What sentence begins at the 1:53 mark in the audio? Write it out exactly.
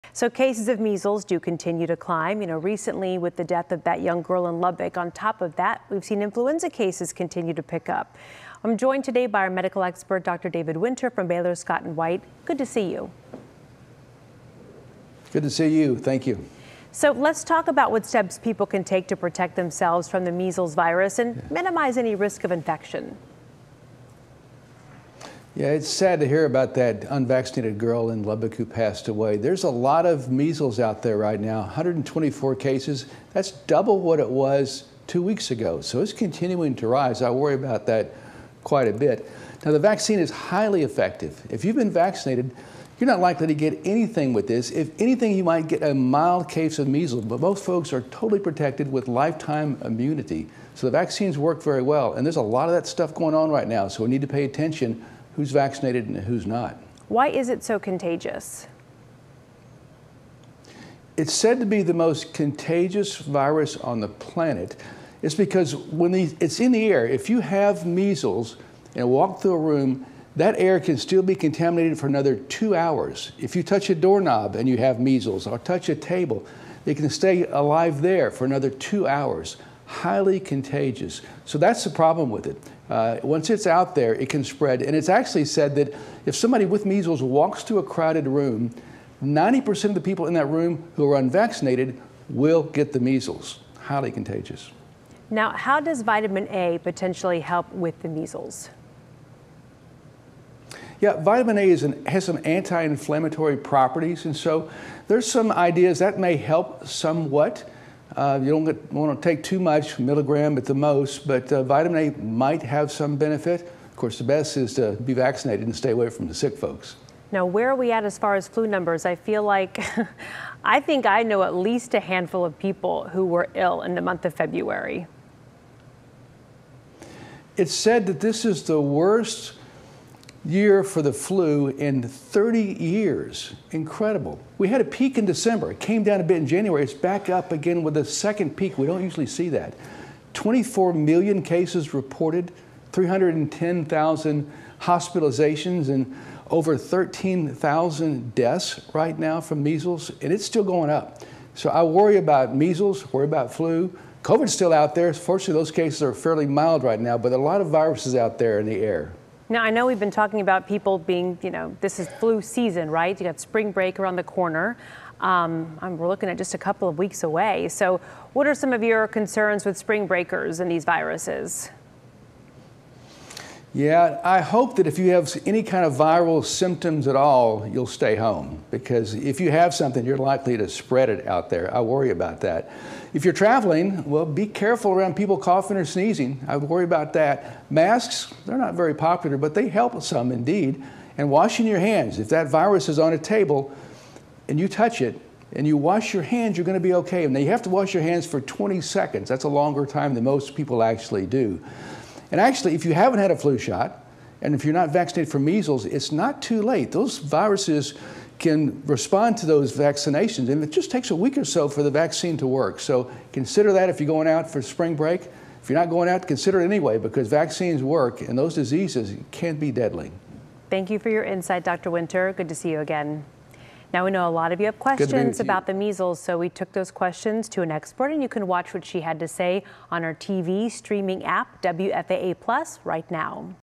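Of course, the best is to be vaccinated and stay away from the sick folks.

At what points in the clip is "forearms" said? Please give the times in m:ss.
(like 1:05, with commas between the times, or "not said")
not said.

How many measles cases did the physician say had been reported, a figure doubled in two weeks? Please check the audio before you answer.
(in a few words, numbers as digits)
124.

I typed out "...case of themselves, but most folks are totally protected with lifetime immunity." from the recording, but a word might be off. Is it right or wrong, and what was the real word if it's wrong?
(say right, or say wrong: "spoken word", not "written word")
wrong: "measles", not "themselves".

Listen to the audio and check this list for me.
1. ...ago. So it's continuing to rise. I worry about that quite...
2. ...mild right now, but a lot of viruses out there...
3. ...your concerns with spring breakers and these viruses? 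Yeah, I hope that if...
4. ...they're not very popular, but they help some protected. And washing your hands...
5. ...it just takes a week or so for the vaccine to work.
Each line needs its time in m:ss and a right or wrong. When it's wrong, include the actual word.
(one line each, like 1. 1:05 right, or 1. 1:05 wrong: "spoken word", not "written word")
1. 0:35 right
2. 2:36 right
3. 2:48 right
4. 3:08 wrong: "indeed", not "protected"
5. 3:30 right.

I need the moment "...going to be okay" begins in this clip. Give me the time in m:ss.
3:16.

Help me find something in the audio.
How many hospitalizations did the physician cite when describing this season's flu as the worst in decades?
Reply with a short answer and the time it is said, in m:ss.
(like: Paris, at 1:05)
310,000, at 2:22.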